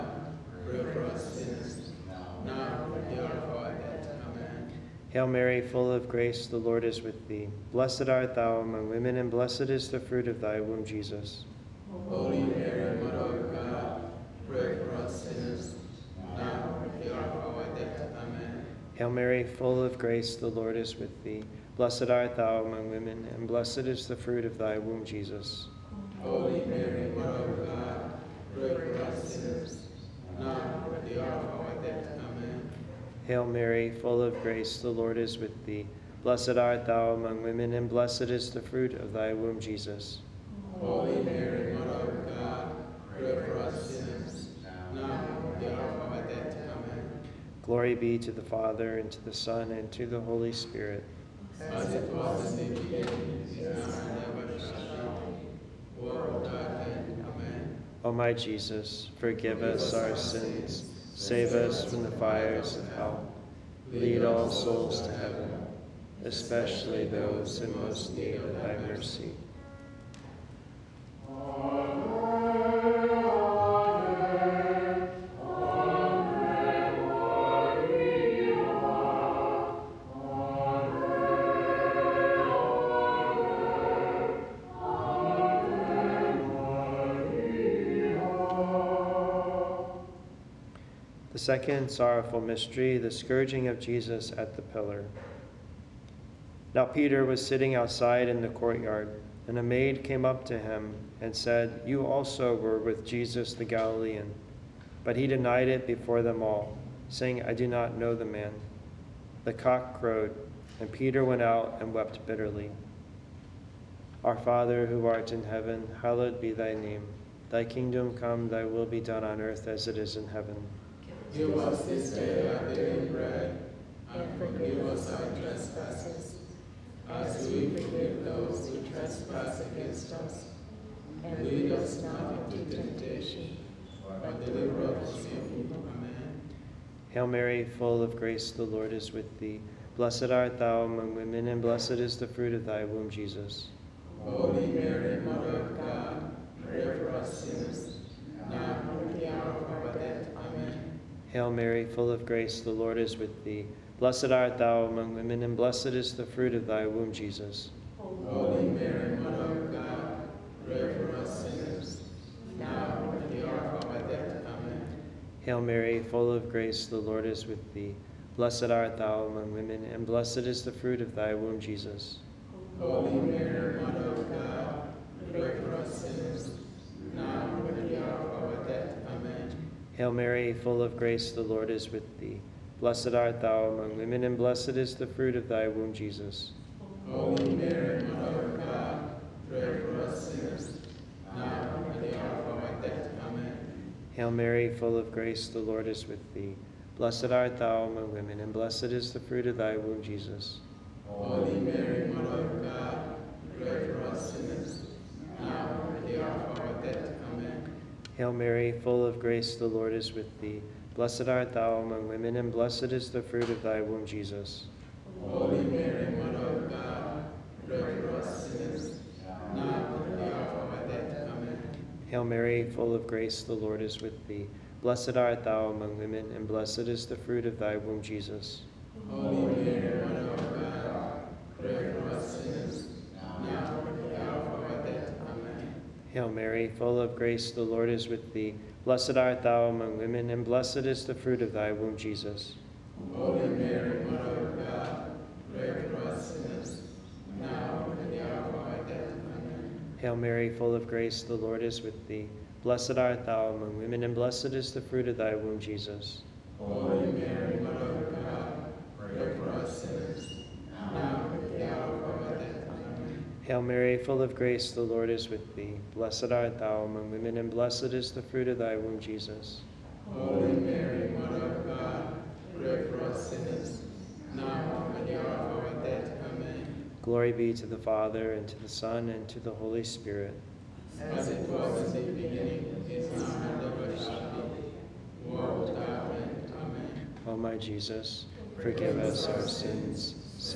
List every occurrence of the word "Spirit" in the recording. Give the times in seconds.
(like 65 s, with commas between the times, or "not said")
50 s, 279 s.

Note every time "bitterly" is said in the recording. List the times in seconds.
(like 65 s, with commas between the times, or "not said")
112 s.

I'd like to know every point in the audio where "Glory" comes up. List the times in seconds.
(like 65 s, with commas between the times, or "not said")
47 s, 277 s.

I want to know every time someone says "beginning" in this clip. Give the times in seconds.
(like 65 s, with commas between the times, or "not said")
52 s, 282 s.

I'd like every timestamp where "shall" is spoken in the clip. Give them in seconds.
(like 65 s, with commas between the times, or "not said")
54 s, 283 s.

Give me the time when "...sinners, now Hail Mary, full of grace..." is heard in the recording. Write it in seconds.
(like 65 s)
176 s.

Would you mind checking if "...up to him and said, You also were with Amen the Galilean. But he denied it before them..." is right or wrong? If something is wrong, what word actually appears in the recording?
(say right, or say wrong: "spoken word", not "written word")
wrong: "Jesus", not "Amen".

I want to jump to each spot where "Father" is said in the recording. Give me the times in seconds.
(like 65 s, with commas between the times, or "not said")
48 s, 114 s, 277 s.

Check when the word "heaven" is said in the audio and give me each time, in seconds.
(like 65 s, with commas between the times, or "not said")
65 s, 115 s, 120 s.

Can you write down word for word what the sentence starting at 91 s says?
second sorrowful mystery, the scourging of Jesus at the pillar.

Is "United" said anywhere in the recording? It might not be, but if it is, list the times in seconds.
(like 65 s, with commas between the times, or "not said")
not said.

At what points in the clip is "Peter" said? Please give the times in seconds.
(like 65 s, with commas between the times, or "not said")
96 s, 110 s.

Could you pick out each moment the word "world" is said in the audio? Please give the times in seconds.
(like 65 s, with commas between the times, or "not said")
56 s, 285 s.